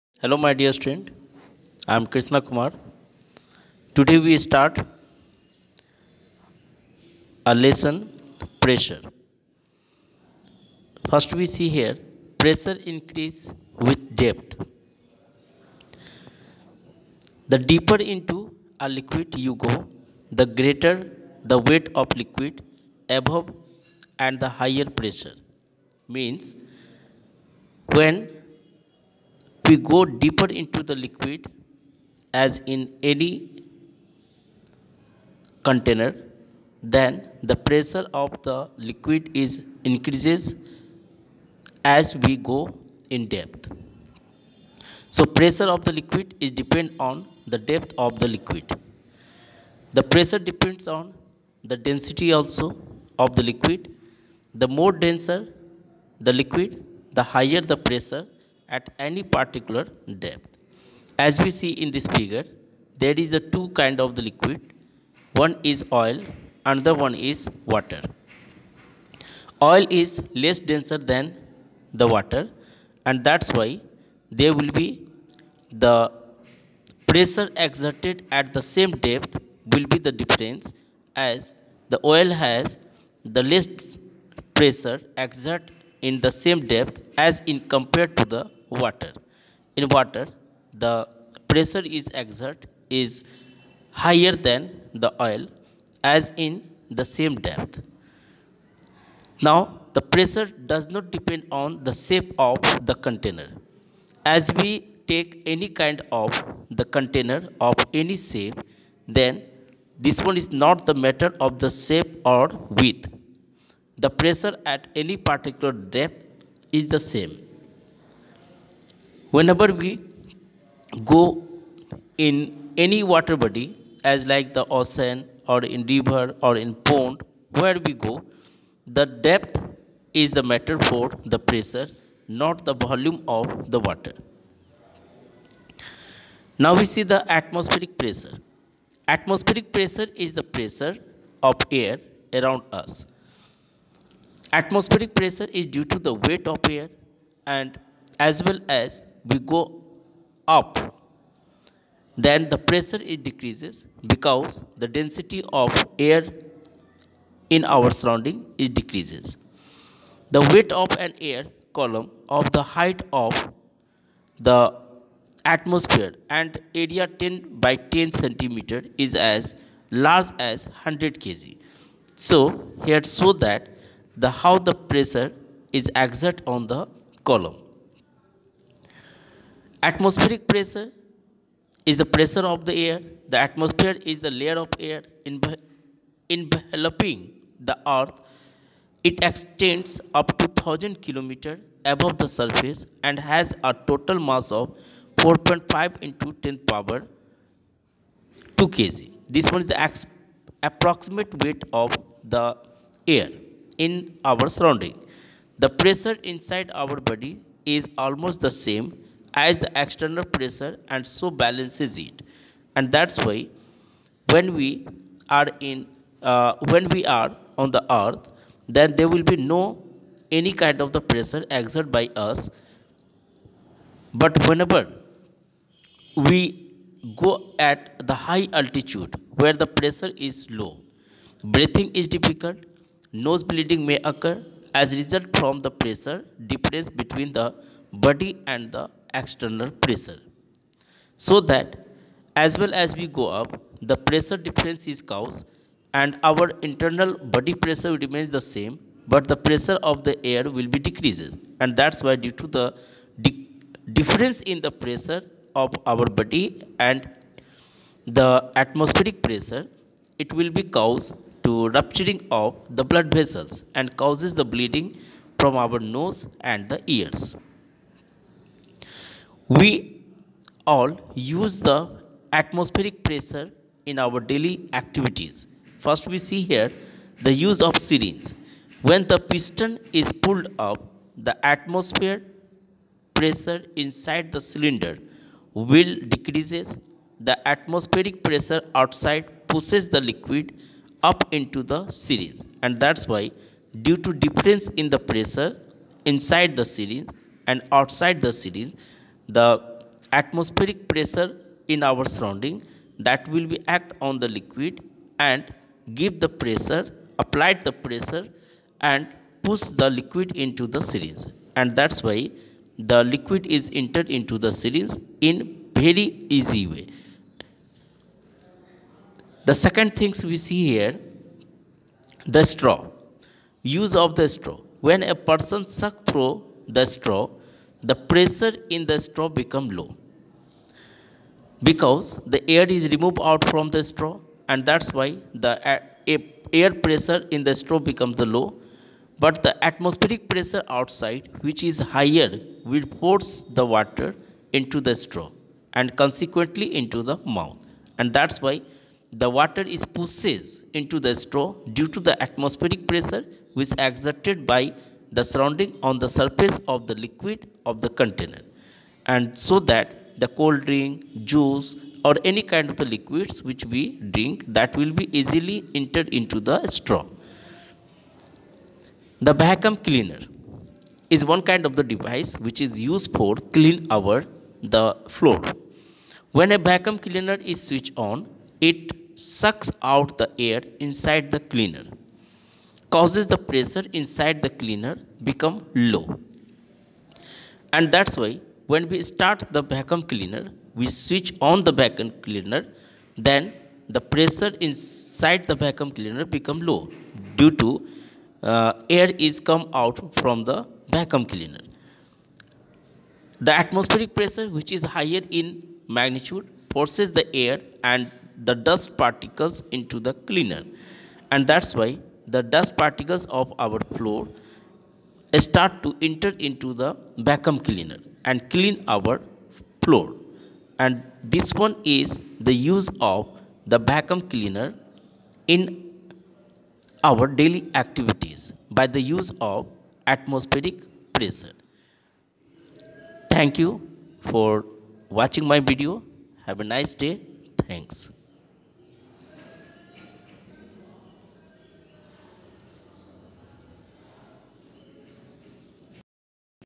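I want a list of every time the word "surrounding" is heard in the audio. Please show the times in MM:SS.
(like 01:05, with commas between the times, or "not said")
02:37, 03:24, 05:02, 05:55.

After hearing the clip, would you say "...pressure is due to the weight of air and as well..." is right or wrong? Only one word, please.
right.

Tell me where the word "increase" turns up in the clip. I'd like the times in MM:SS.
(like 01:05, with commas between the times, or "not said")
00:12, 00:39.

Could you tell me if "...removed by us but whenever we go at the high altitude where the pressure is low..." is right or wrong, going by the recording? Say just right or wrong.
wrong.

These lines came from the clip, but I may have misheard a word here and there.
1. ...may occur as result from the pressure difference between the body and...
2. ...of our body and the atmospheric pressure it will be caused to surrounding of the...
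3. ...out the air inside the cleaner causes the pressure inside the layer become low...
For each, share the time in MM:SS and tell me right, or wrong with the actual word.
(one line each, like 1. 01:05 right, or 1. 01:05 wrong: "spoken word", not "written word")
1. 03:53 right
2. 04:15 wrong: "rupturing", not "surrounding"
3. 06:19 wrong: "cleaner", not "layer".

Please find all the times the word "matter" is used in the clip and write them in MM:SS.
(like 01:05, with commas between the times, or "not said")
01:51, 02:10.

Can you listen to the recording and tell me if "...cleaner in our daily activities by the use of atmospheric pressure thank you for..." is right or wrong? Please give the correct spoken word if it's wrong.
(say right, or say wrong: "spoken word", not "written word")
right.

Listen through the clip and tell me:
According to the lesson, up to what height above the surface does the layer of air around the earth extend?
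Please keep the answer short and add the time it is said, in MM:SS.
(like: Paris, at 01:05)
1000 km, at 03:10.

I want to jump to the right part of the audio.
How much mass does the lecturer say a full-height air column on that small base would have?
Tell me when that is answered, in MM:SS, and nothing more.
02:50.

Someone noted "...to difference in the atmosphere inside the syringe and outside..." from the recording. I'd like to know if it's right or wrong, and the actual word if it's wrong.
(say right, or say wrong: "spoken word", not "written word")
wrong: "pressure", not "atmosphere".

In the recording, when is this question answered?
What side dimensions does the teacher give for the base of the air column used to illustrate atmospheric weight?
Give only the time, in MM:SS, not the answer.
02:47.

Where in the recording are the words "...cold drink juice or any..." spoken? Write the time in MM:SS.
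06:00.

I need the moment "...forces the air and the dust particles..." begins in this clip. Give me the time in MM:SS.
06:46.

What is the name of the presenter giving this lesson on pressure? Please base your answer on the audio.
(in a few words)
Krishna Kumar.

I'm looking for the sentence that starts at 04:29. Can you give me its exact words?
We all use the atmospheric pressure in our daily activities.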